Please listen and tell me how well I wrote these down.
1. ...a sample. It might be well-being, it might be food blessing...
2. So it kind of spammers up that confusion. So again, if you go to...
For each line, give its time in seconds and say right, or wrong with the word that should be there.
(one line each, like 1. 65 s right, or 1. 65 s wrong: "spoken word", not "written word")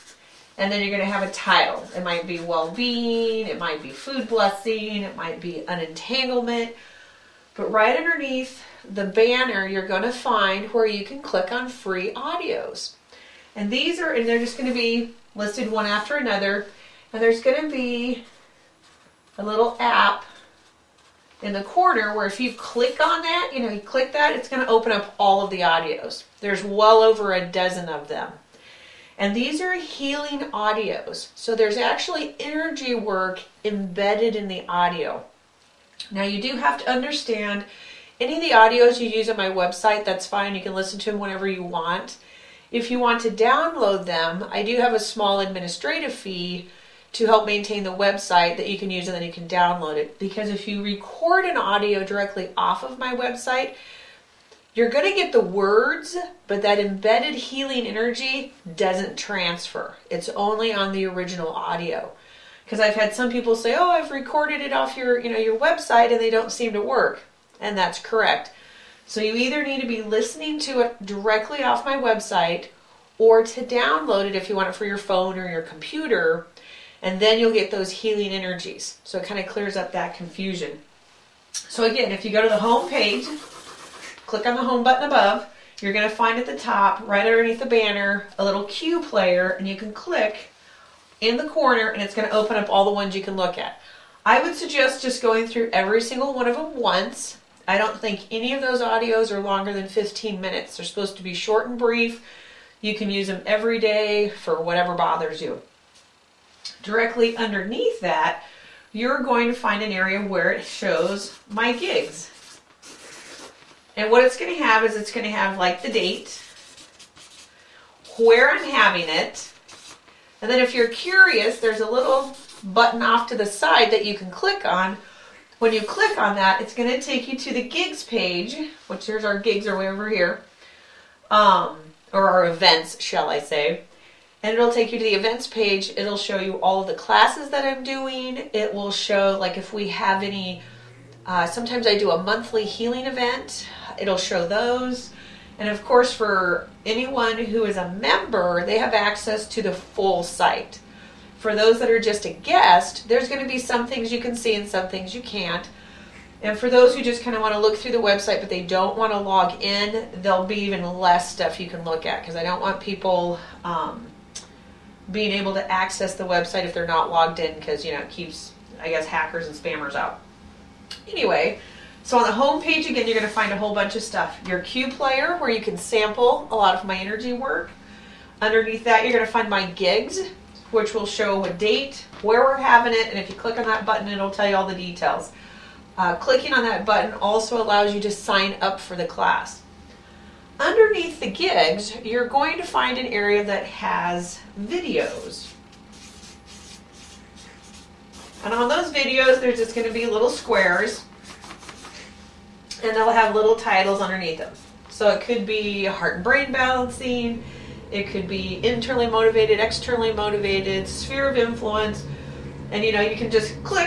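1. 1 s wrong: "title", not "sample"
2. 79 s wrong: "clears", not "spammers".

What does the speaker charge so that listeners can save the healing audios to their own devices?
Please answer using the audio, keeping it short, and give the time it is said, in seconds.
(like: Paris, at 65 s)
a small administrative fee, at 44 s.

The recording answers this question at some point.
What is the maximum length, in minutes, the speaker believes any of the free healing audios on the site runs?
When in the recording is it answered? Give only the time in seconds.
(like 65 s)
99 s.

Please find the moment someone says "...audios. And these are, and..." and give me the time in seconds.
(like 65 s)
12 s.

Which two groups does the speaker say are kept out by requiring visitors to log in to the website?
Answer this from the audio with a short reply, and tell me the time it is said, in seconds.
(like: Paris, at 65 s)
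hackers and spammers, at 169 s.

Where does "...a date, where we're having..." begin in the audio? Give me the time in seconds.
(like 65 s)
181 s.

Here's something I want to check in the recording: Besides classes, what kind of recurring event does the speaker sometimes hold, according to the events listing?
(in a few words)
a monthly healing event.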